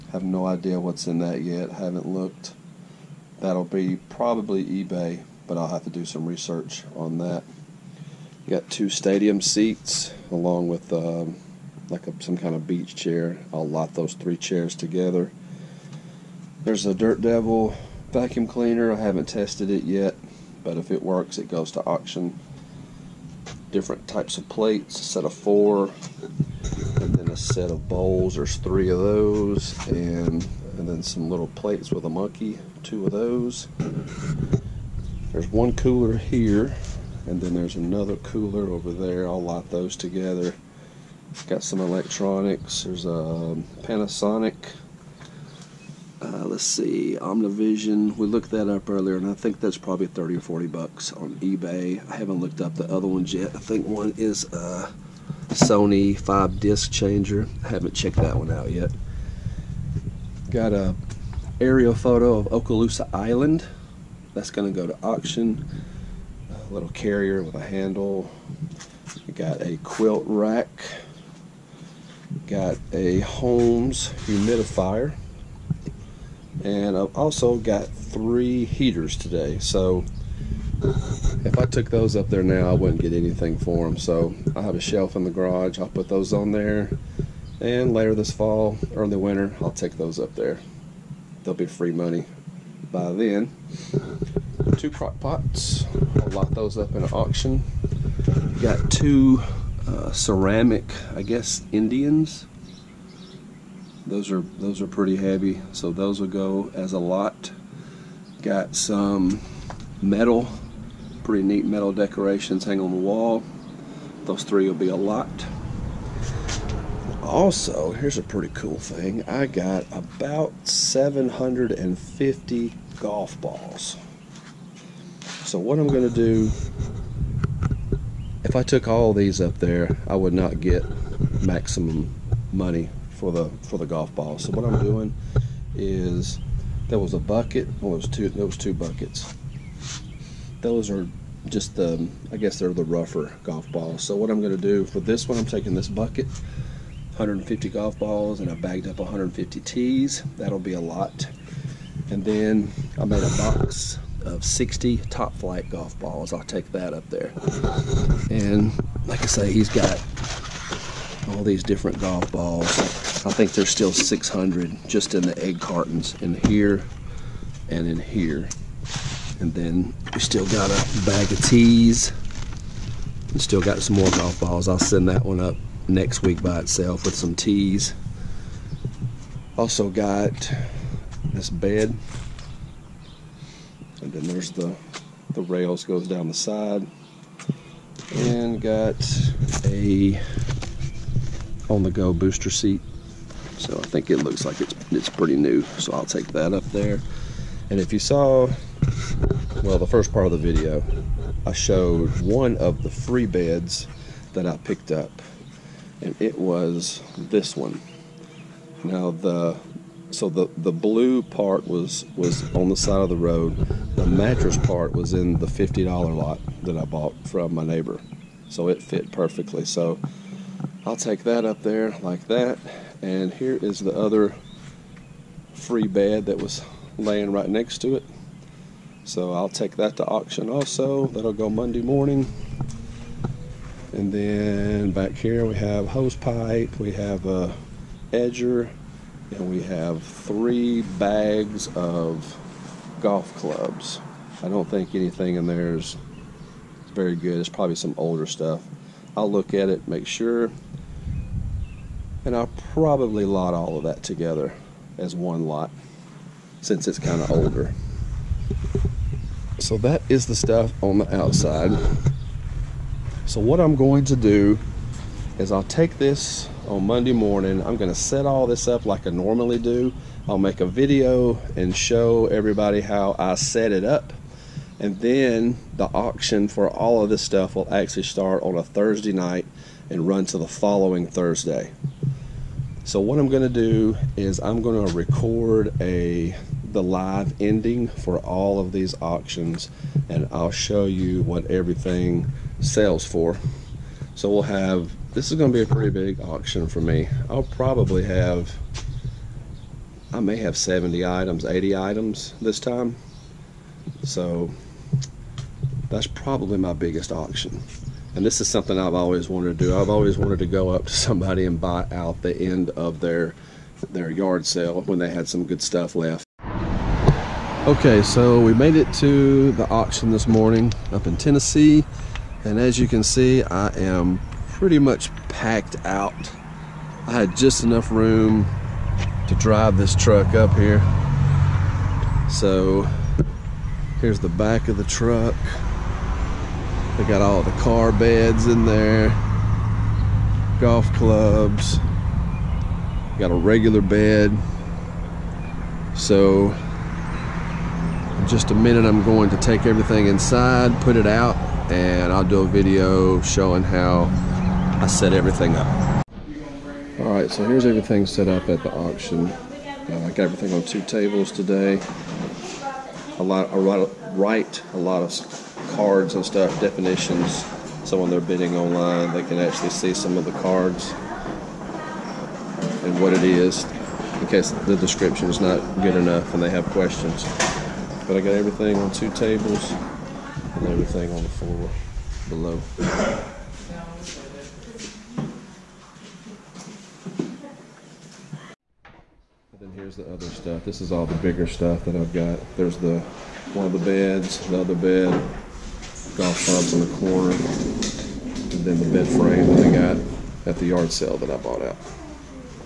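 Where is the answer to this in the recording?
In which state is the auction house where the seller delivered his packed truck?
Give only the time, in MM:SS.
05:21.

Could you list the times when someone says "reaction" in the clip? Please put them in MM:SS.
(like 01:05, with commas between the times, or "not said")
not said.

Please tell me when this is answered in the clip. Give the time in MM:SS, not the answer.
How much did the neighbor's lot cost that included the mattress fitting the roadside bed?
03:35.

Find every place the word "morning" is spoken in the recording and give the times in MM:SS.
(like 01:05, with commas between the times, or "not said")
03:51, 04:27, 05:20.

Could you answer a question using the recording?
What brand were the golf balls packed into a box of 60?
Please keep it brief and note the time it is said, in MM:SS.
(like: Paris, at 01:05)
Top-Flite, at 02:35.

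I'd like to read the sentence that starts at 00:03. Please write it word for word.
That'll be probably eBay, but I'll have to do some research on that.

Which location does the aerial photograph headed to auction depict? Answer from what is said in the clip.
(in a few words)
Okaloosa Island.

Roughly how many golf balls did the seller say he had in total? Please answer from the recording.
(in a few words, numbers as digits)
750.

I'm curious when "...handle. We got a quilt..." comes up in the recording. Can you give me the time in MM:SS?
01:07.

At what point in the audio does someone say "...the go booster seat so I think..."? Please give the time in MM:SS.
03:11.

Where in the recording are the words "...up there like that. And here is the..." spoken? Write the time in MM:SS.
03:41.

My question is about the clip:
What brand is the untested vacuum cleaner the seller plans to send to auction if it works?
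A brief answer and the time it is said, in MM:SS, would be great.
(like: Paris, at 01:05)
Dirt Devil, at 00:16.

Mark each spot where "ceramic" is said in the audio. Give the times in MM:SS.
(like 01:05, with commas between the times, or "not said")
01:40.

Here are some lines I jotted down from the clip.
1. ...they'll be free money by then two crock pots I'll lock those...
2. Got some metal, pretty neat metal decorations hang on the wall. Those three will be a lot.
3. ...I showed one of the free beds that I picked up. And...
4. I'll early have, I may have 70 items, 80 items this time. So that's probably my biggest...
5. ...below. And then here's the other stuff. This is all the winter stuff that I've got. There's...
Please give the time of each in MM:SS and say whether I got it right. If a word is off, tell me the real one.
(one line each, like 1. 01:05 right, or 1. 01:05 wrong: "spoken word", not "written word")
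1. 01:31 right
2. 01:48 right
3. 03:21 right
4. 04:57 wrong: "probably", not "early"
5. 06:22 wrong: "bigger", not "winter".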